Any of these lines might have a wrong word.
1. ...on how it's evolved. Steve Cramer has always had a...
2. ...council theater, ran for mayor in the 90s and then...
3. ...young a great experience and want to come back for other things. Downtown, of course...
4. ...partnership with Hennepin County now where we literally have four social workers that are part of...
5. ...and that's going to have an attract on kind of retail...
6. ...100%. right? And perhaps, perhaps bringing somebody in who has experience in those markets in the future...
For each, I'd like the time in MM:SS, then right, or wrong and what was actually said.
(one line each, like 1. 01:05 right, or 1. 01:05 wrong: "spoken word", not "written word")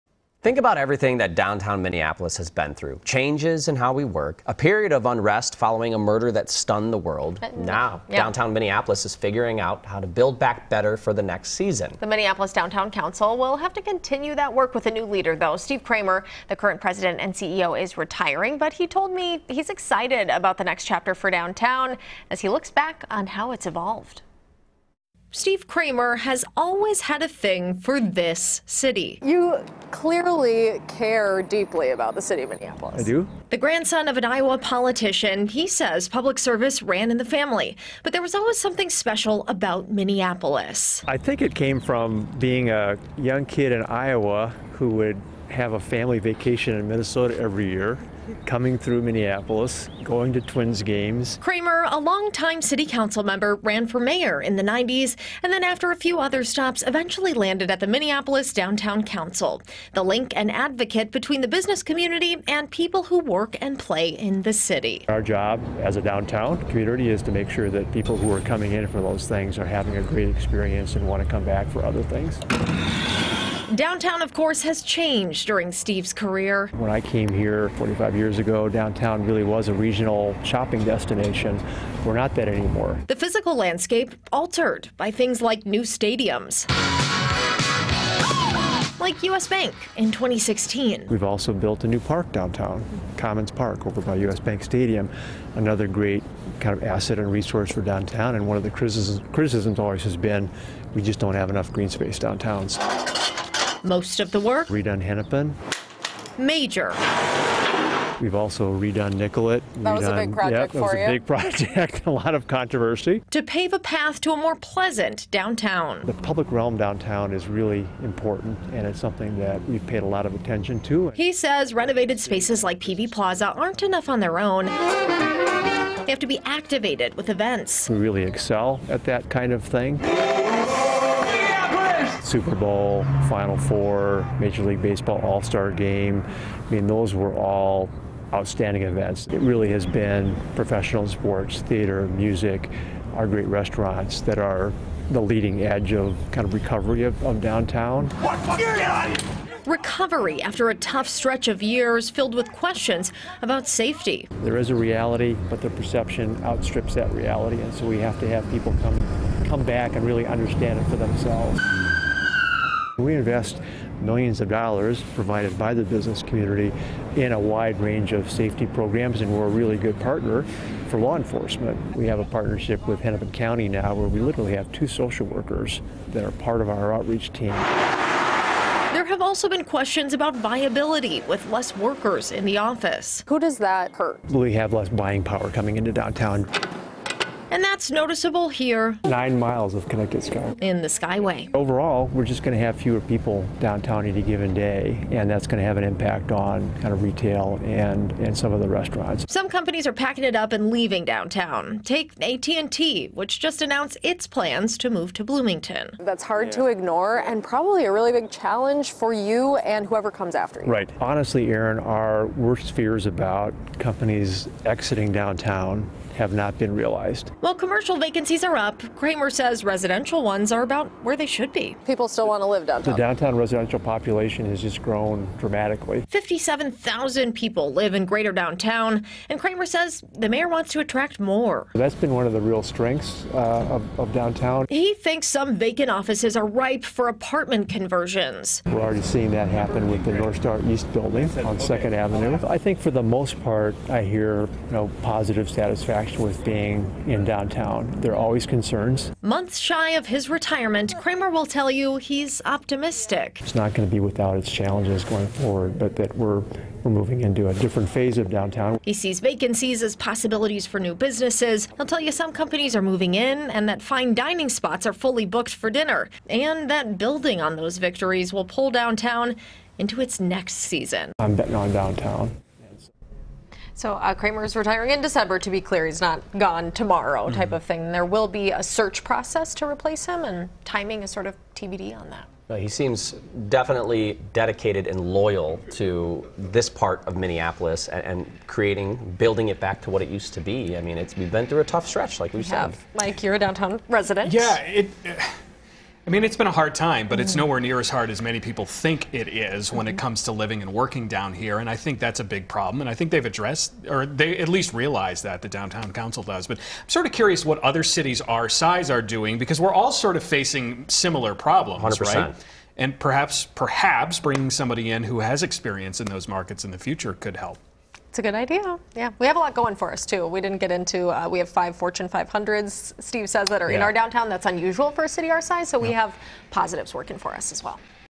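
1. 00:23 right
2. 00:52 wrong: "member", not "theater"
3. 01:09 wrong: "having", not "young"
4. 02:52 wrong: "two", not "four"
5. 03:15 wrong: "impact", not "attract"
6. 05:11 right.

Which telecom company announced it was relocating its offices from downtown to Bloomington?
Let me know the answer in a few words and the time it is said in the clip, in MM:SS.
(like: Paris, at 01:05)
AT&T, at 03:22.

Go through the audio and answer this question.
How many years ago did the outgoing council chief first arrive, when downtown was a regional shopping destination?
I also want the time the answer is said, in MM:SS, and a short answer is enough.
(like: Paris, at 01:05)
45, at 01:17.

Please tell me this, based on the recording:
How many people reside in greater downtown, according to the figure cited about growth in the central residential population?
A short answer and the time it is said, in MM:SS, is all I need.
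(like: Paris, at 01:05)
57,000, at 03:46.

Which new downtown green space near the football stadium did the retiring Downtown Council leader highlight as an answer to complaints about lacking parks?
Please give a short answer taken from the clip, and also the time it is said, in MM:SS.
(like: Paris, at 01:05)
Commons Park, at 01:33.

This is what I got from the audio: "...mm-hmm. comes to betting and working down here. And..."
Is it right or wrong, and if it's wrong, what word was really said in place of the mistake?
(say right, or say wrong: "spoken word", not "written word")
wrong: "living", not "betting".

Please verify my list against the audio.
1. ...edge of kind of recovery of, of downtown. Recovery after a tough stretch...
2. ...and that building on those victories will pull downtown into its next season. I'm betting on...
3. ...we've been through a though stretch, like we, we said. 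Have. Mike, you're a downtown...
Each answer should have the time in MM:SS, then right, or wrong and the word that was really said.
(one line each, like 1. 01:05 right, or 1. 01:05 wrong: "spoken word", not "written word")
1. 02:25 right
2. 04:26 right
3. 04:51 wrong: "tough", not "though".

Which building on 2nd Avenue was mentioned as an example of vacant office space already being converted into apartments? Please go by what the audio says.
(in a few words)
North Star East.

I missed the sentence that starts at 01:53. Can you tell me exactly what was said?
To pave a path to a more pleasant downtown.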